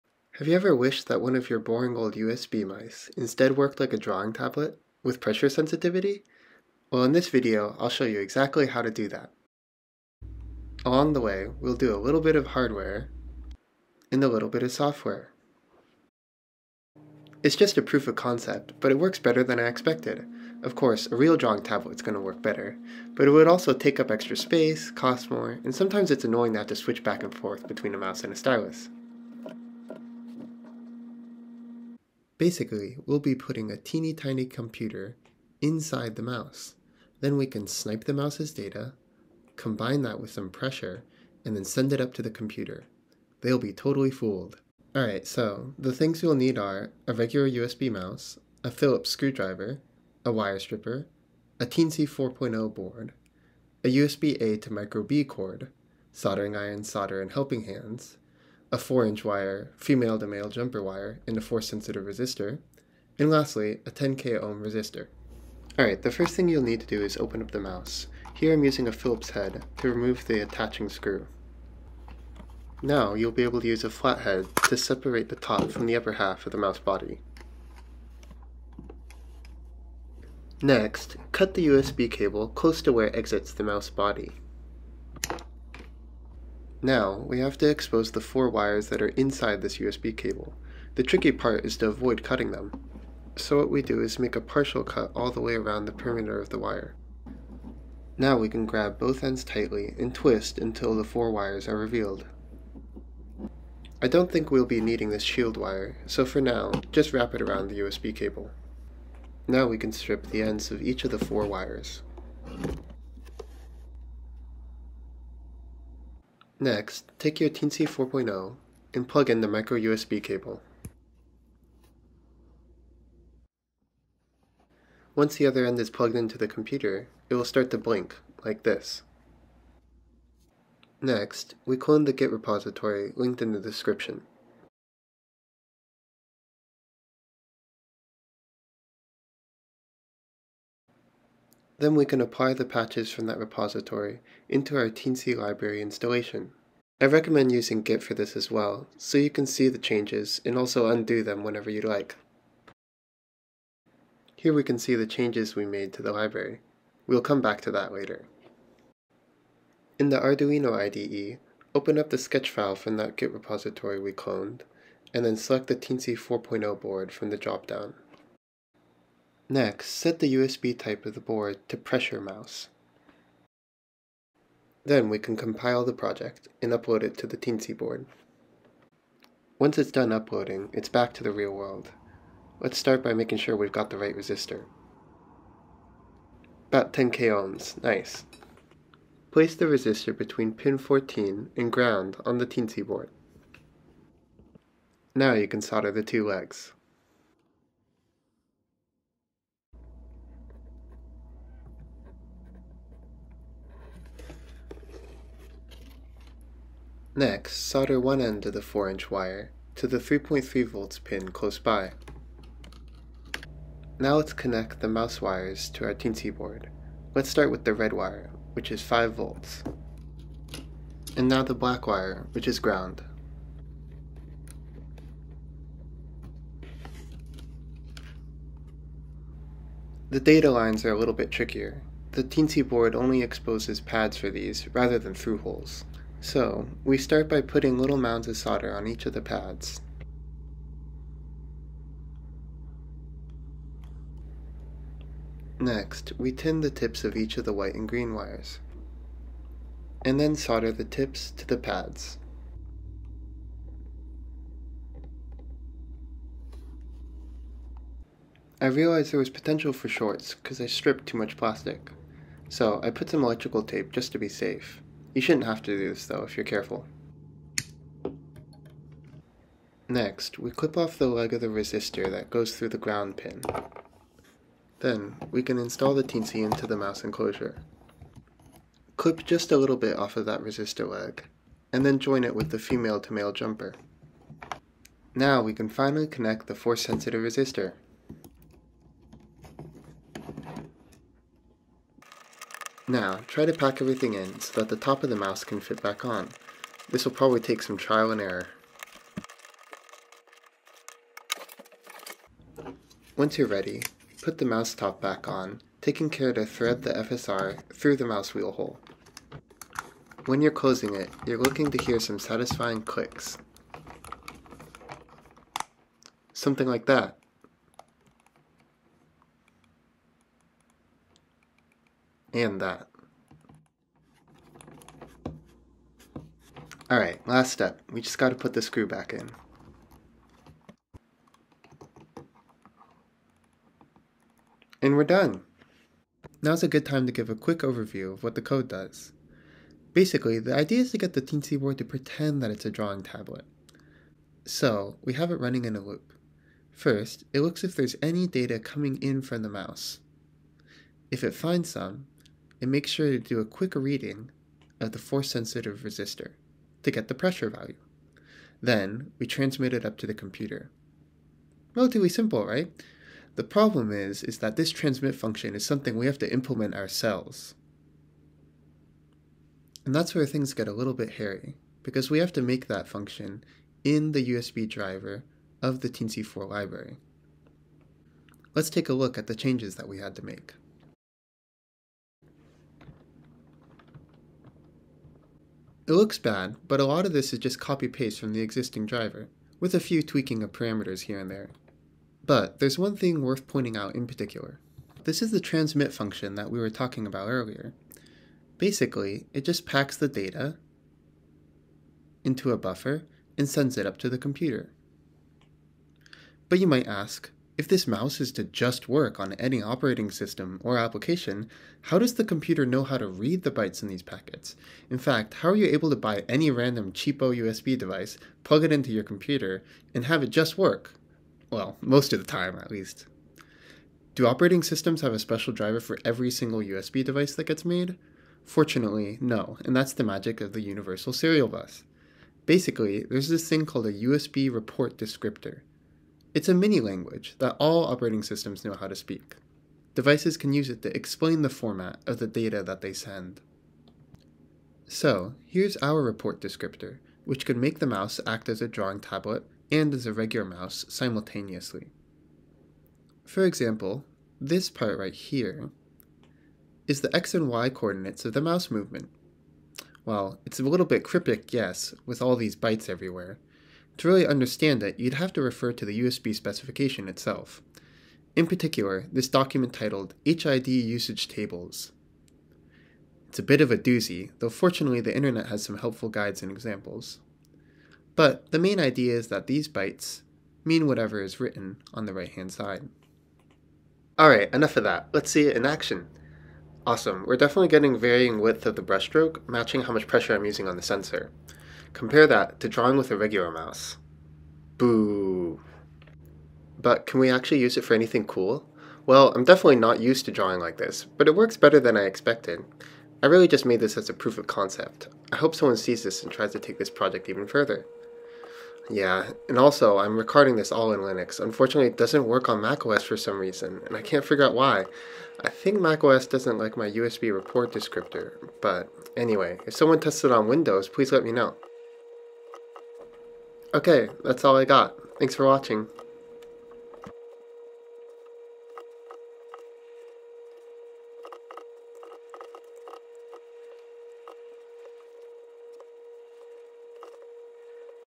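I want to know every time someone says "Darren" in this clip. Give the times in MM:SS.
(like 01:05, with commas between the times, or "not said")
not said.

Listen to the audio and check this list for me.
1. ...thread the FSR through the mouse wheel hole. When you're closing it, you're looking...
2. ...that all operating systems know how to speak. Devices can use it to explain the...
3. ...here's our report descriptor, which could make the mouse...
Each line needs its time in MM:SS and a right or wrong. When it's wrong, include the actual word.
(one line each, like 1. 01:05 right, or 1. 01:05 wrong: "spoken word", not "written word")
1. 05:06 right
2. 07:17 right
3. 07:25 right.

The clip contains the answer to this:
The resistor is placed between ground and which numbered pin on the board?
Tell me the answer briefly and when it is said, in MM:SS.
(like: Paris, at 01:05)
14, at 03:10.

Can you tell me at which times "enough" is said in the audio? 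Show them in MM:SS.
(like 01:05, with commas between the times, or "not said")
08:04.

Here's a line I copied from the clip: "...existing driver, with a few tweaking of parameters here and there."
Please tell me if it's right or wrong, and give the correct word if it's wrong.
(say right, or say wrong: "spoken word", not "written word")
right.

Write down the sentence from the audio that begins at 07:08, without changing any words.
Fortunately, no, and that's the magic of the Universal Serial Bus.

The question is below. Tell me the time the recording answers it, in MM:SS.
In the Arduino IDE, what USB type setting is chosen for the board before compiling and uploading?
02:51.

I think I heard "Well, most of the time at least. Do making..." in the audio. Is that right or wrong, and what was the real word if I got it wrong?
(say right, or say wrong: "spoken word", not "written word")
wrong: "operating", not "making".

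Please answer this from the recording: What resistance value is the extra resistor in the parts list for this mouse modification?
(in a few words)
10k ohm.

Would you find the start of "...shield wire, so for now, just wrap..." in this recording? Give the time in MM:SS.
01:45.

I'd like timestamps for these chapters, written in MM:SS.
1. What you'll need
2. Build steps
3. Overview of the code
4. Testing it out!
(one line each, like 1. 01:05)
1. 00:45
2. 01:05
3. 05:38
4. 08:02.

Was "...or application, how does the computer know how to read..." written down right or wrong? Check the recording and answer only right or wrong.
right.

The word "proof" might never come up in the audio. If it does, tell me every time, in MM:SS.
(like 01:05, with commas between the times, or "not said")
00:17, 08:24.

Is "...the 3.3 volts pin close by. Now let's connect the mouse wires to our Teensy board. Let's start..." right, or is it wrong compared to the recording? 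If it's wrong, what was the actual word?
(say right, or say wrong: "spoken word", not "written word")
right.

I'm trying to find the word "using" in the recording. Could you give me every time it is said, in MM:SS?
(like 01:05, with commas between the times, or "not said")
01:08, 02:27, 08:10.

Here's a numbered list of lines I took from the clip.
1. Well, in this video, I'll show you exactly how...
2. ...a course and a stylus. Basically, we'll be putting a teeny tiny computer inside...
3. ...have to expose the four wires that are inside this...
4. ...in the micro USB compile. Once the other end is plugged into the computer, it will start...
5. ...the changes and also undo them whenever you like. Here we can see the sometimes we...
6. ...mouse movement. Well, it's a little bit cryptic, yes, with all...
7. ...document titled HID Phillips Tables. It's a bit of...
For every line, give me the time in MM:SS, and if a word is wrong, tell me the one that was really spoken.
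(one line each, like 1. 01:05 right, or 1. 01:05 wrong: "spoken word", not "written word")
1. 00:06 right
2. 00:27 wrong: "mouse", not "course"
3. 01:27 right
4. 01:59 wrong: "cable", not "compile"
5. 02:29 wrong: "changes", not "sometimes"
6. 07:38 right
7. 07:49 wrong: "Usage", not "Phillips".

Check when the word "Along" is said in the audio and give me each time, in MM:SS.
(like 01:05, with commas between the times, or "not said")
00:10.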